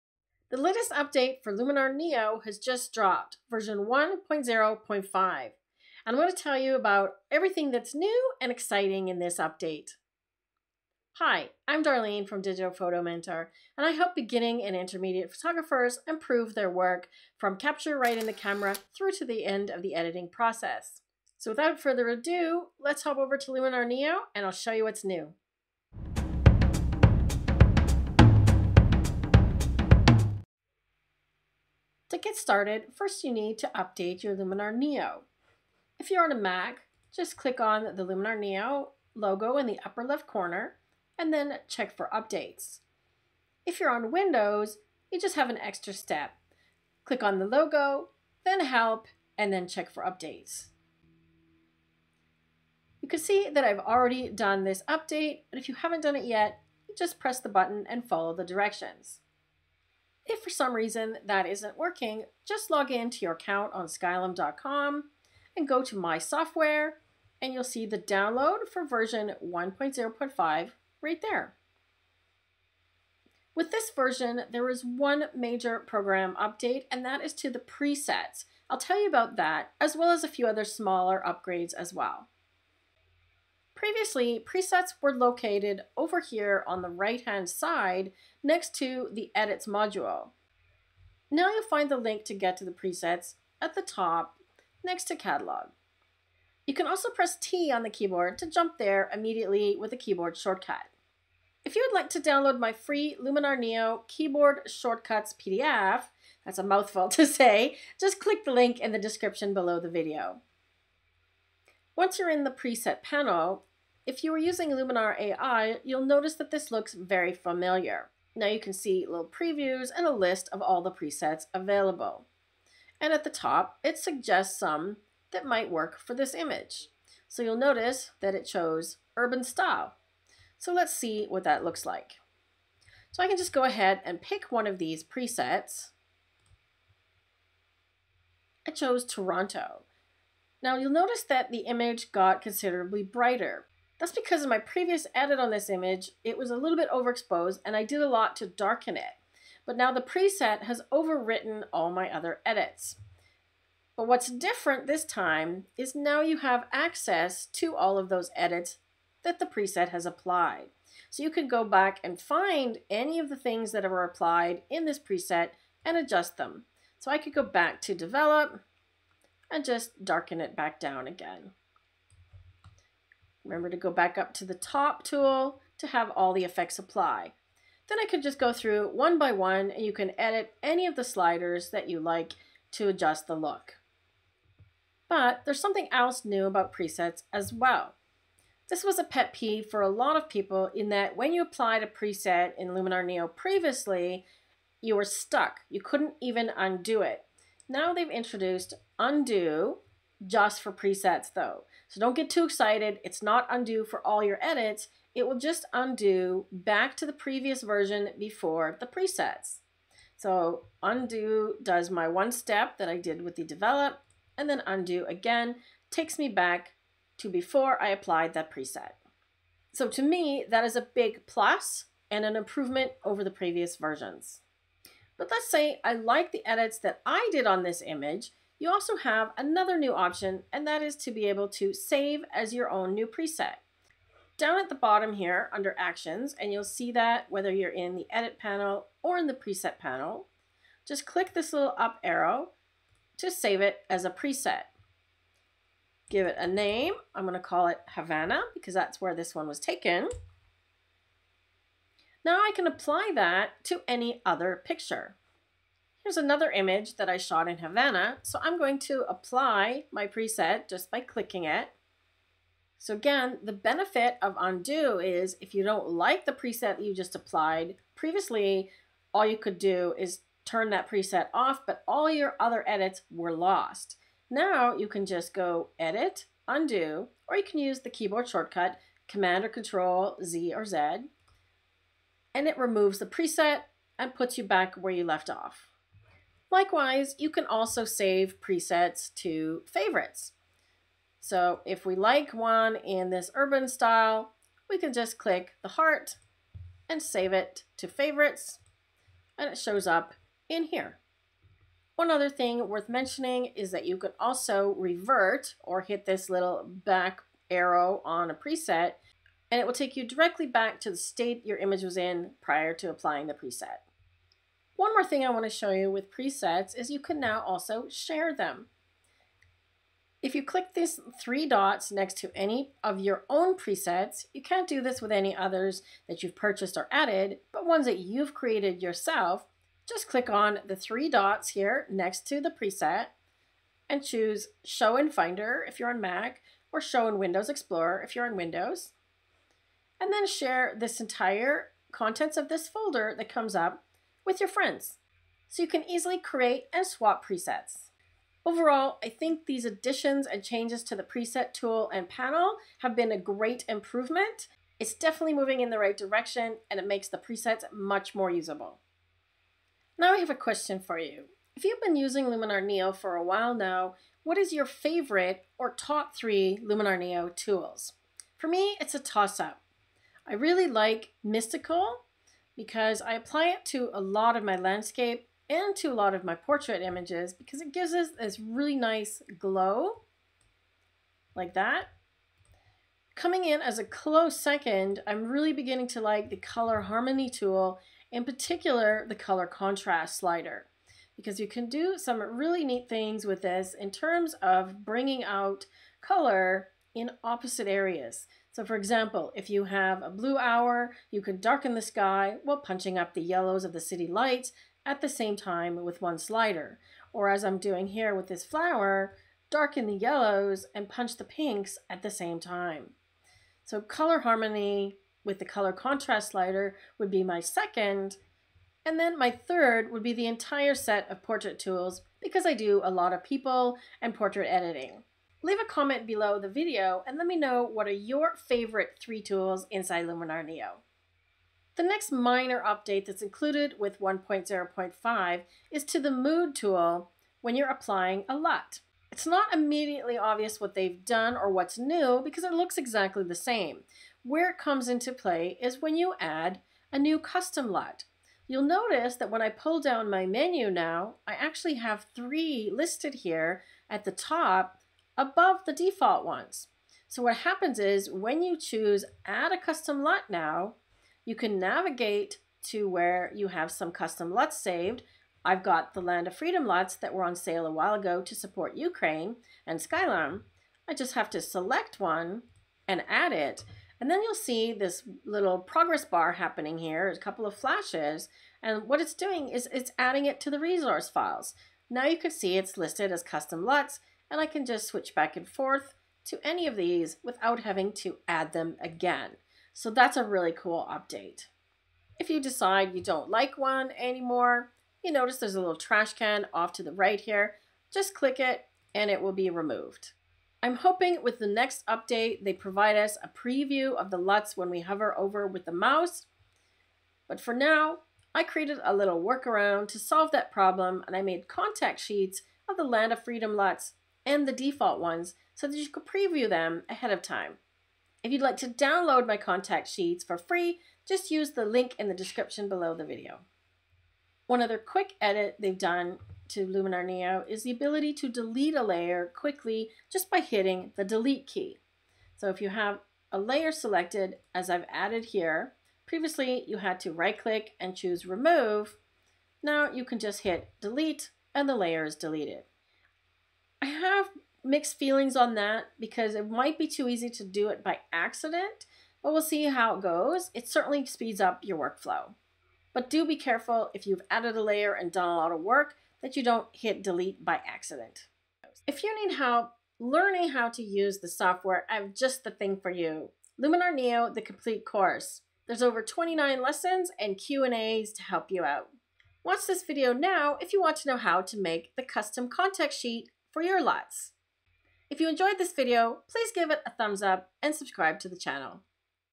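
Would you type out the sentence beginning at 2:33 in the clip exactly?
But what's different this time is now you have access to all of those edits that the preset has applied.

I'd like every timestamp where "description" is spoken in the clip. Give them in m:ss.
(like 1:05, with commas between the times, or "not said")
1:48, 8:42.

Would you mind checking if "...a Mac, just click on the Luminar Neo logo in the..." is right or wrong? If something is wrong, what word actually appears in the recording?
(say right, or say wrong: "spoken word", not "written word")
right.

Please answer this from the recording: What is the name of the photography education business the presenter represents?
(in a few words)
Digital Photo Mentor.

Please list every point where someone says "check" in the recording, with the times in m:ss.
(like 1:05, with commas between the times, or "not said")
0:41, 0:49.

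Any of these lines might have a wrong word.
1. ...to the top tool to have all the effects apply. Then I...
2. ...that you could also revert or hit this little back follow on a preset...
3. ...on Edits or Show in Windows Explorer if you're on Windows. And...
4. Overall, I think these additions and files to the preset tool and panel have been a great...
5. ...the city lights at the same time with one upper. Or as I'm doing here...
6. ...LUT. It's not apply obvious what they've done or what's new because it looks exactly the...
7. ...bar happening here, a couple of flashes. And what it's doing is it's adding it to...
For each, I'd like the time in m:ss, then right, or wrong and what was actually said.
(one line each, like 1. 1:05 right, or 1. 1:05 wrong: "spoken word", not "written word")
1. 2:54 right
2. 5:03 wrong: "arrow", not "follow"
3. 5:35 wrong: "Mac", not "Edits"
4. 5:48 wrong: "changes", not "files"
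5. 6:43 wrong: "slider", not "upper"
6. 7:18 wrong: "immediately", not "apply"
7. 7:56 right.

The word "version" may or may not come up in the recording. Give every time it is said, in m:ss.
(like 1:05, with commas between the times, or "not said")
0:03, 1:08, 1:13, 3:27, 3:43.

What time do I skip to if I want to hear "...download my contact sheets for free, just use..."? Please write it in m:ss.
8:38.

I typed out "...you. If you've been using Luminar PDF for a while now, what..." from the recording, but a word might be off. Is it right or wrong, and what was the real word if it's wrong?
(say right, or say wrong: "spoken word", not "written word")
wrong: "Neo", not "PDF".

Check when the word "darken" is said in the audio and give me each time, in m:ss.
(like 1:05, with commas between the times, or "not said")
2:28, 2:50, 6:41, 6:49.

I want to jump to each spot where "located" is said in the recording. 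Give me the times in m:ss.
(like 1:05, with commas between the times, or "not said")
1:25.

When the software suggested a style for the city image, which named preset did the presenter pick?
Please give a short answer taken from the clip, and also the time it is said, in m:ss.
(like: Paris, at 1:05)
Toronto, at 2:19.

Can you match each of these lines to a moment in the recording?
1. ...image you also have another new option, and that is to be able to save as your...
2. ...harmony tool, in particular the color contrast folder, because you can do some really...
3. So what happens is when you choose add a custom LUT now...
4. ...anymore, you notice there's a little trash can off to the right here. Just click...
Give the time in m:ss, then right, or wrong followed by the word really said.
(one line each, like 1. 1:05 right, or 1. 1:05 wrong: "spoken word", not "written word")
1. 3:47 right
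2. 6:26 wrong: "slider", not "folder"
3. 7:37 right
4. 8:13 right.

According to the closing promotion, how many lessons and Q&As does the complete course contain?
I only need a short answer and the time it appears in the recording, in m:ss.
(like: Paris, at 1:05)
over 29, at 9:25.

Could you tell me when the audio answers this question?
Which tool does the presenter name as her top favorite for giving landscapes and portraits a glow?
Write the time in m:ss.
6:11.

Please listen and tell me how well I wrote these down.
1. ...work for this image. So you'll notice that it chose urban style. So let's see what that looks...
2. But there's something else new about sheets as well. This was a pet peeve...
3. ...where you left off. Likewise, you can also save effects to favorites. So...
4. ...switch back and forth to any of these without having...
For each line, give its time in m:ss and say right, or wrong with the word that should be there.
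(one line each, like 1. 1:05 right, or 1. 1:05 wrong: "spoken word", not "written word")
1. 2:05 right
2. 3:05 wrong: "presets", not "sheets"
3. 4:44 wrong: "presets", not "effects"
4. 8:04 right.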